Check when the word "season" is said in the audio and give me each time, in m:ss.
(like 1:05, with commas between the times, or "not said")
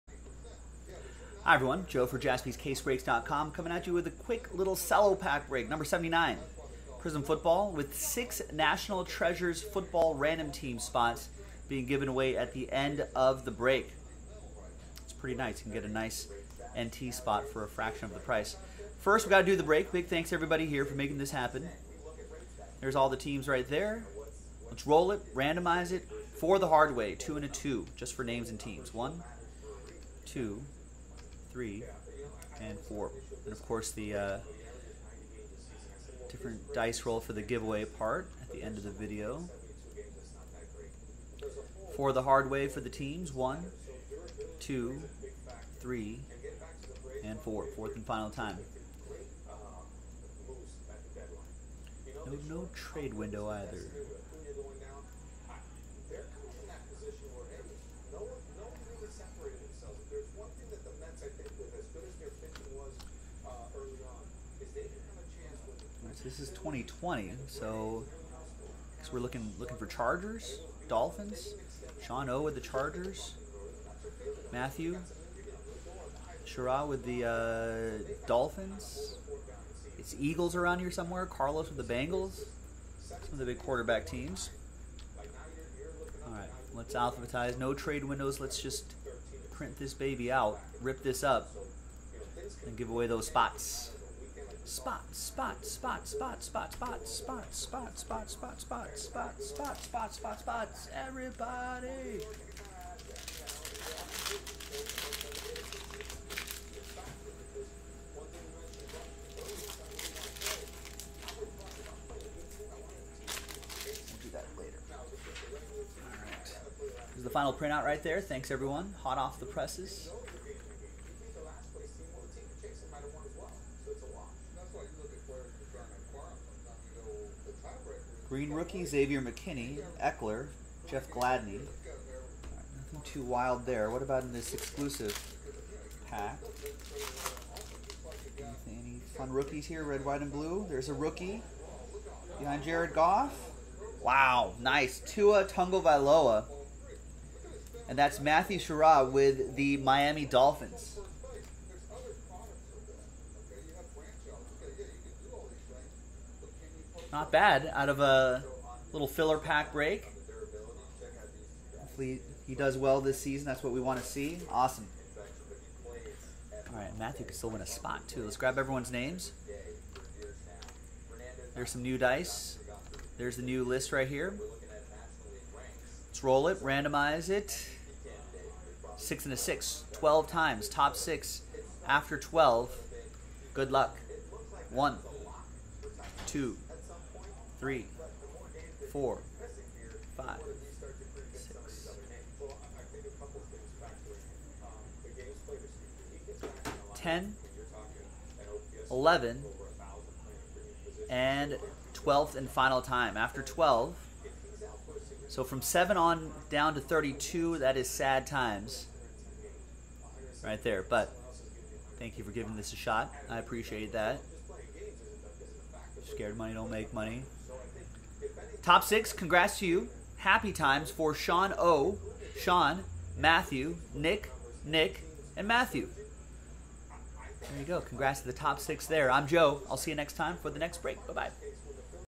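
2:43.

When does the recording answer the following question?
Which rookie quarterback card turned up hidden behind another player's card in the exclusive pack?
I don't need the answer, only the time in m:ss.
2:25.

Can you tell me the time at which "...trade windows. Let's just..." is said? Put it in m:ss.
1:27.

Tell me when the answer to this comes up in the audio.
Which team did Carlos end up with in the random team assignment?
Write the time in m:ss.
1:21.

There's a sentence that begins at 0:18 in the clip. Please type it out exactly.
First, we got to do the break.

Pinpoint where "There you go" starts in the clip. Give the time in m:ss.
3:47.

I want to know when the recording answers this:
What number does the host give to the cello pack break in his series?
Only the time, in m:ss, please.
0:05.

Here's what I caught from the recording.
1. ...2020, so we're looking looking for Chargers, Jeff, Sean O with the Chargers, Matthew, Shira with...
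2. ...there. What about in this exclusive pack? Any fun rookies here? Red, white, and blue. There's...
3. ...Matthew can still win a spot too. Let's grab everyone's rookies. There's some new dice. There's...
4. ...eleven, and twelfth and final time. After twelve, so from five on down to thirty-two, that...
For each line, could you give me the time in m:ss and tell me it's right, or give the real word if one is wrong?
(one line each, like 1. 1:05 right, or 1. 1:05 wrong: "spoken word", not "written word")
1. 1:06 wrong: "Dolphins", not "Jeff"
2. 2:13 right
3. 2:46 wrong: "names", not "rookies"
4. 3:18 wrong: "seven", not "five".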